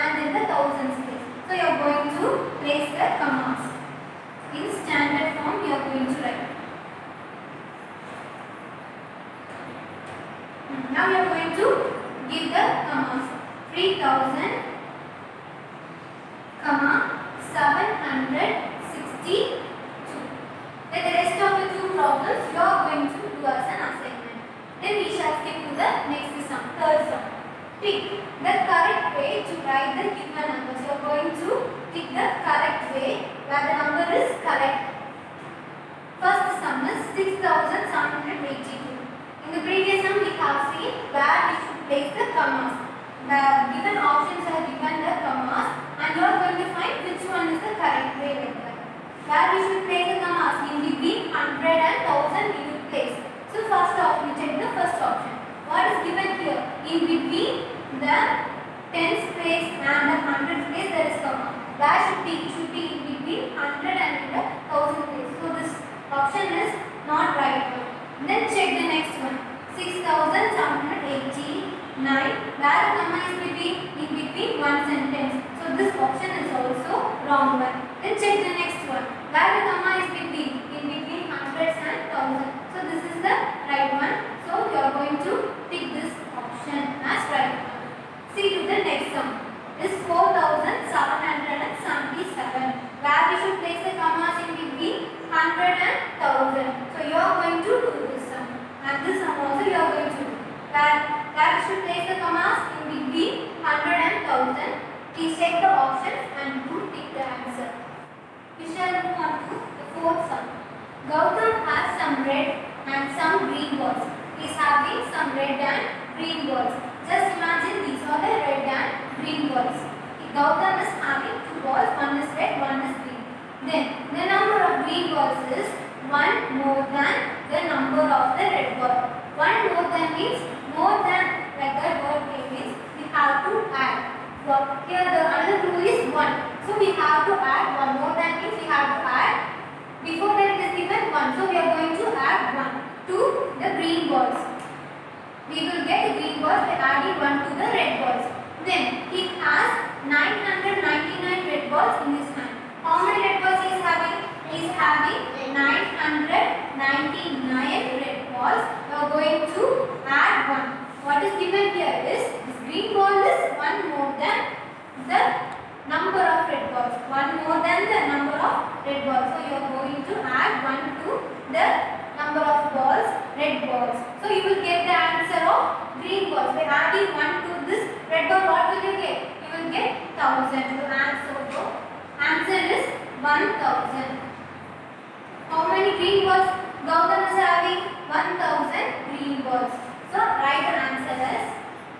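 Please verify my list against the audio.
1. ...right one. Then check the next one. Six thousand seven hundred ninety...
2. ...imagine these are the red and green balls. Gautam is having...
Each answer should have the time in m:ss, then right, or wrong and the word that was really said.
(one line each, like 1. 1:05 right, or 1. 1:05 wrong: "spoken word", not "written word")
1. 1:07 wrong: "eighty", not "ninety"
2. 1:57 right.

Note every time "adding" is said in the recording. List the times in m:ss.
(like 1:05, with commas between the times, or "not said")
2:26, 2:56.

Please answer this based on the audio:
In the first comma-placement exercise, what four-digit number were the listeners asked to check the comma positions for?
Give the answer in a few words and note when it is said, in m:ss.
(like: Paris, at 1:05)
6782, at 0:37.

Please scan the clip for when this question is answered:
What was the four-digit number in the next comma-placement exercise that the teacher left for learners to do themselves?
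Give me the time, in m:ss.
1:30.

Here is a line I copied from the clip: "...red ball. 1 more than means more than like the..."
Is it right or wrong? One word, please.
right.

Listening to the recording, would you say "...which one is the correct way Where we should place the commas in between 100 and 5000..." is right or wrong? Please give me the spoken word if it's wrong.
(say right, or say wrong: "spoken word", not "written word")
wrong: "1000", not "5000".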